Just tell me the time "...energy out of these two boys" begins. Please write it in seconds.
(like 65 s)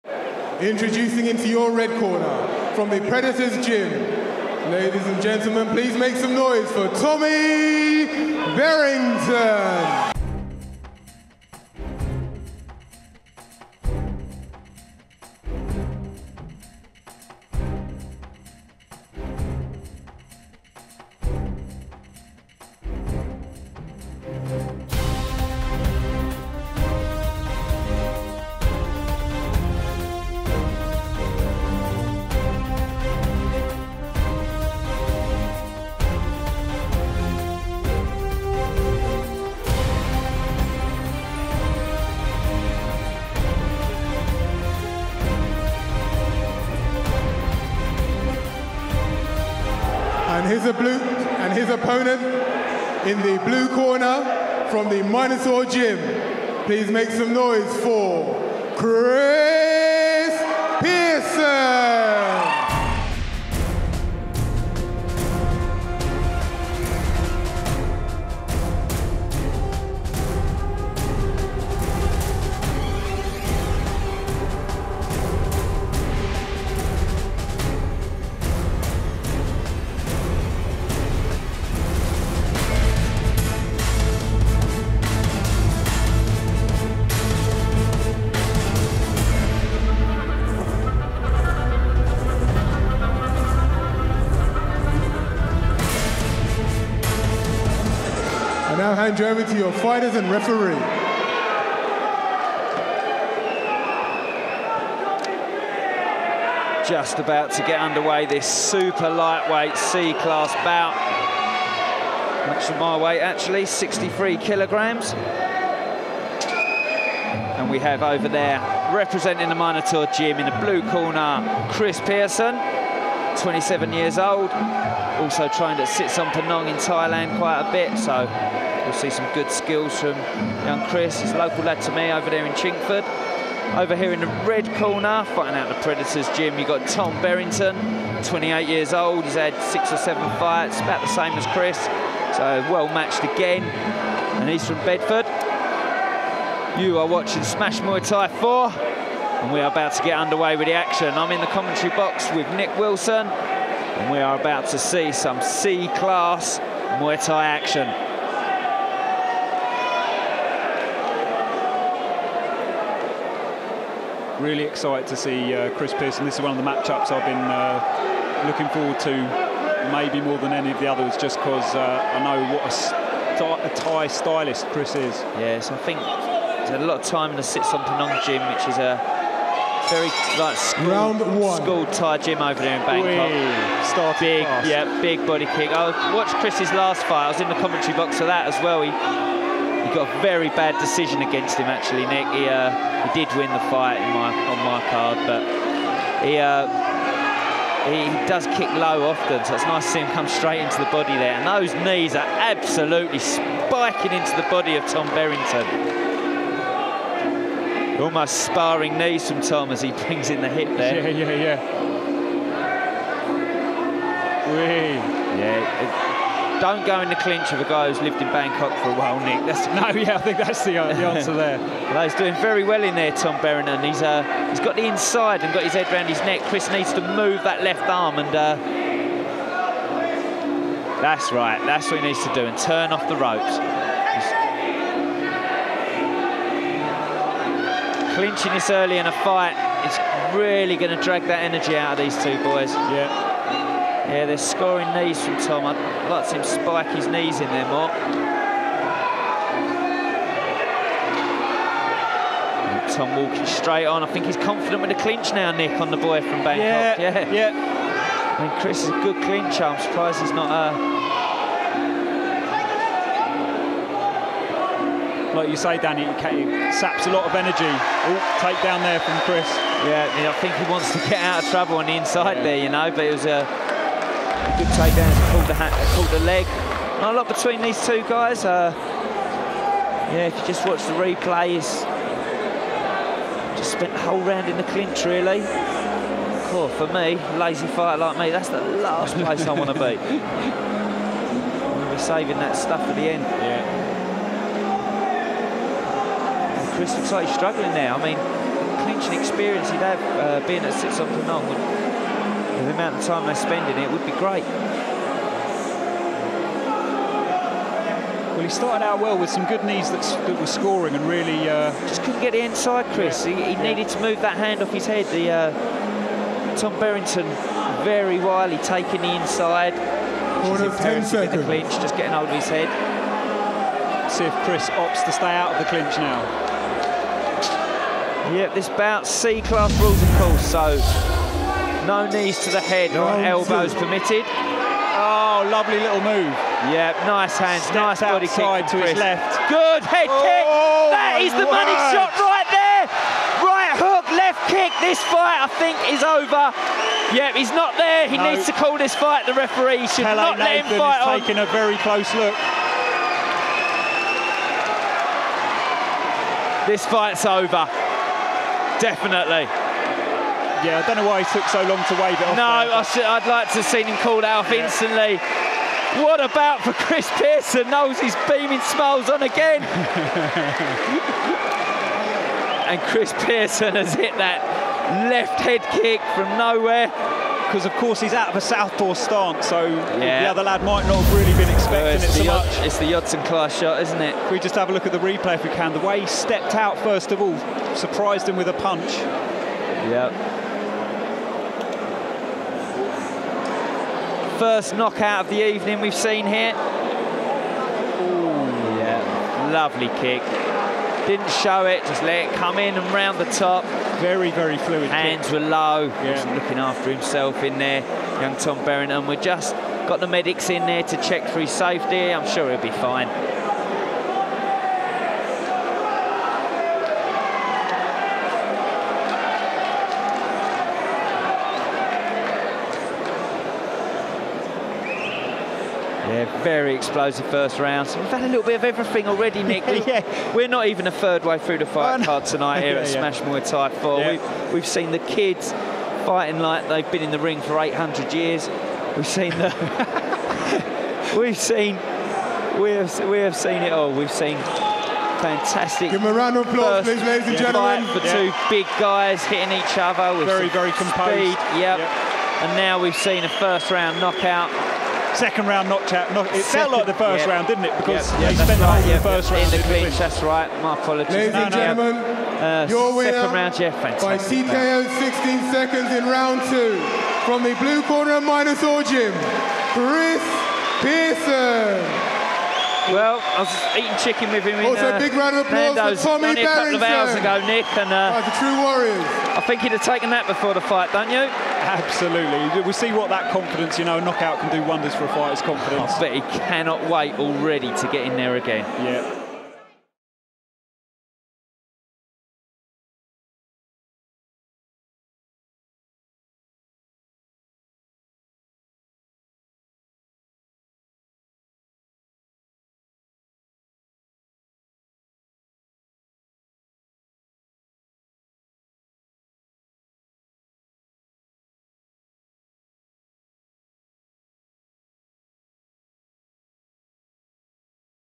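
241 s.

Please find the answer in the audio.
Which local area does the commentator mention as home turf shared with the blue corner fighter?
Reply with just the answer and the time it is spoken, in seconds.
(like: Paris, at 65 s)
Chingford, at 132 s.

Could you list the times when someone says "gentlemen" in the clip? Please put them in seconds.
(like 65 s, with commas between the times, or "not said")
5 s, 447 s, 461 s.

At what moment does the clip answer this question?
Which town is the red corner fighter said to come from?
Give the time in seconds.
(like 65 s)
144 s.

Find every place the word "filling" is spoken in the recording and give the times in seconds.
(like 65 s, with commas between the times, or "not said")
not said.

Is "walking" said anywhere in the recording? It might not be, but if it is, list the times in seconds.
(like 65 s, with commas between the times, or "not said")
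253 s.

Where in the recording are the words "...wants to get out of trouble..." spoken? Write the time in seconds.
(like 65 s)
270 s.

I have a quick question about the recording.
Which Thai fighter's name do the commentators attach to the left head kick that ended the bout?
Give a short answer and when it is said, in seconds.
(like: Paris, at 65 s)
Yodsanklai, at 382 s.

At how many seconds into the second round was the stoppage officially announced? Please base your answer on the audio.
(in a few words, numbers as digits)
16.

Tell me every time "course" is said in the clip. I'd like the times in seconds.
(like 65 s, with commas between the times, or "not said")
330 s, 377 s.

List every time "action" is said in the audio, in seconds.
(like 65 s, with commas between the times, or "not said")
150 s, 157 s.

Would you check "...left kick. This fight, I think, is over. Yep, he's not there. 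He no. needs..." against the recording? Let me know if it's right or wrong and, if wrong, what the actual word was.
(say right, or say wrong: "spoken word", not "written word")
right.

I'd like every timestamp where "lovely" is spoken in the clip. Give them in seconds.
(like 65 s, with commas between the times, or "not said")
335 s, 399 s.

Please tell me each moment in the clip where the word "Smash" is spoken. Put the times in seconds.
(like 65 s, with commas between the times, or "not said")
147 s, 432 s.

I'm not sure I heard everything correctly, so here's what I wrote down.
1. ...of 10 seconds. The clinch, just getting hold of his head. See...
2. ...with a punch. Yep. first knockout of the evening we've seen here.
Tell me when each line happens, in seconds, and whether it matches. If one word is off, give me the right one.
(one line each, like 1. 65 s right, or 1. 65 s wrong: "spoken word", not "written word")
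1. 320 s right
2. 388 s right.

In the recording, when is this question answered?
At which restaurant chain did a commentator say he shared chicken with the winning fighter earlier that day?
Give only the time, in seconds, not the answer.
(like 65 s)
475 s.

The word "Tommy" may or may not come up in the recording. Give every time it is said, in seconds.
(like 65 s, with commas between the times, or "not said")
6 s, 476 s.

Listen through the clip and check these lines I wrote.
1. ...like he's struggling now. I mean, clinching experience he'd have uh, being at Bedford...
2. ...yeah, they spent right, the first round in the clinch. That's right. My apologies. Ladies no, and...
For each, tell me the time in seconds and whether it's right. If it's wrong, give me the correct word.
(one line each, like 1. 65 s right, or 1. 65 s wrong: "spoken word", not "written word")
1. 297 s wrong: "Sitsongpeenong", not "Bedford"
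2. 458 s right.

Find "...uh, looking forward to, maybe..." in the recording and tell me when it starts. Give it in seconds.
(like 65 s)
167 s.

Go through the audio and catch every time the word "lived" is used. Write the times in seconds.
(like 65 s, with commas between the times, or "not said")
218 s.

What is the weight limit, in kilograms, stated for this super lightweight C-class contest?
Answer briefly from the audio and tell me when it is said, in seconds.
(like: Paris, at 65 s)
63, at 113 s.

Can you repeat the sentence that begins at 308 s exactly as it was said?
Well, he started out well with some good knees that, that were scoring and really...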